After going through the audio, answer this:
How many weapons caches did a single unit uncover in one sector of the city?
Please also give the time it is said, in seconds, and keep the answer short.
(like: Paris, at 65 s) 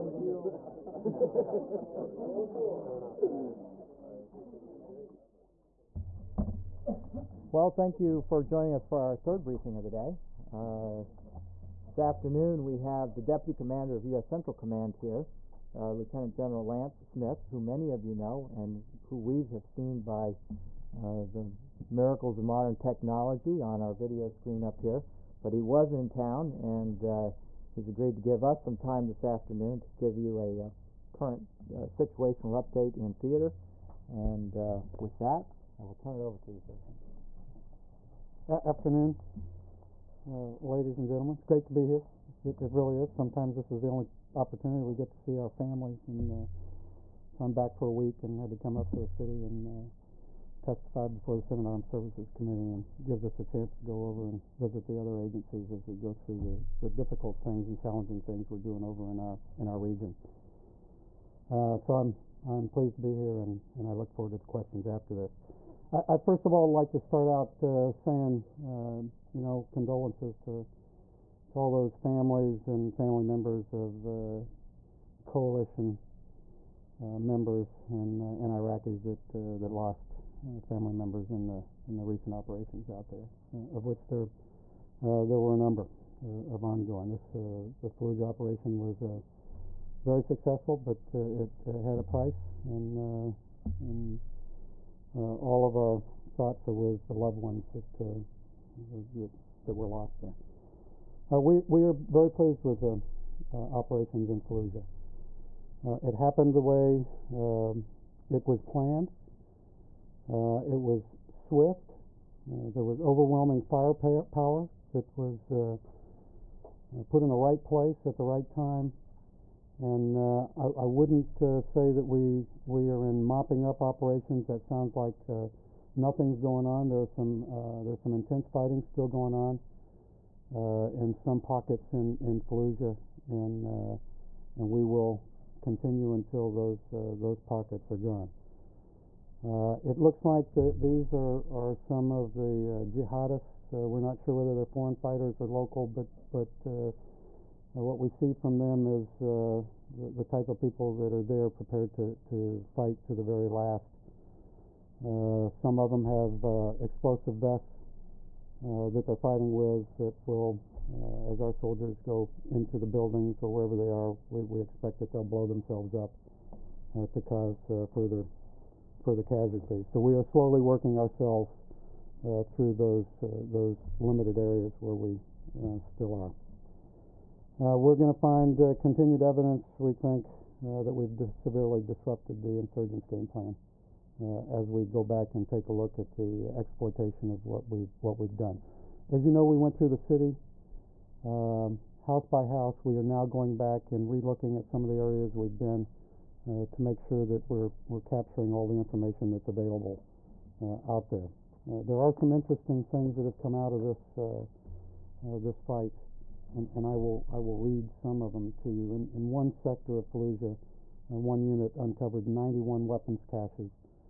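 91, at 212 s.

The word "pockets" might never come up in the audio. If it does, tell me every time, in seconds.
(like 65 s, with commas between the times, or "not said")
131 s, 137 s.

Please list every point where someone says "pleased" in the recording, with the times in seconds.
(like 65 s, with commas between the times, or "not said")
62 s, 102 s.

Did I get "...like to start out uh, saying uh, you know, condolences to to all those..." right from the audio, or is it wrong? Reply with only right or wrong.
right.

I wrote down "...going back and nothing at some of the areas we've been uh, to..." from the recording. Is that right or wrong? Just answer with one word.
wrong.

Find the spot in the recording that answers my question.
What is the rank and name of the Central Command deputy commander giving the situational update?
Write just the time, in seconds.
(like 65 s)
15 s.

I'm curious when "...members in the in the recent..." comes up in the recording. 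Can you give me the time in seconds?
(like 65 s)
80 s.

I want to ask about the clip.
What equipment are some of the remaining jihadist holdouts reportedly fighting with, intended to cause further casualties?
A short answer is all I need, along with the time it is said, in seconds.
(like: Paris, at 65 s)
explosive vests, at 156 s.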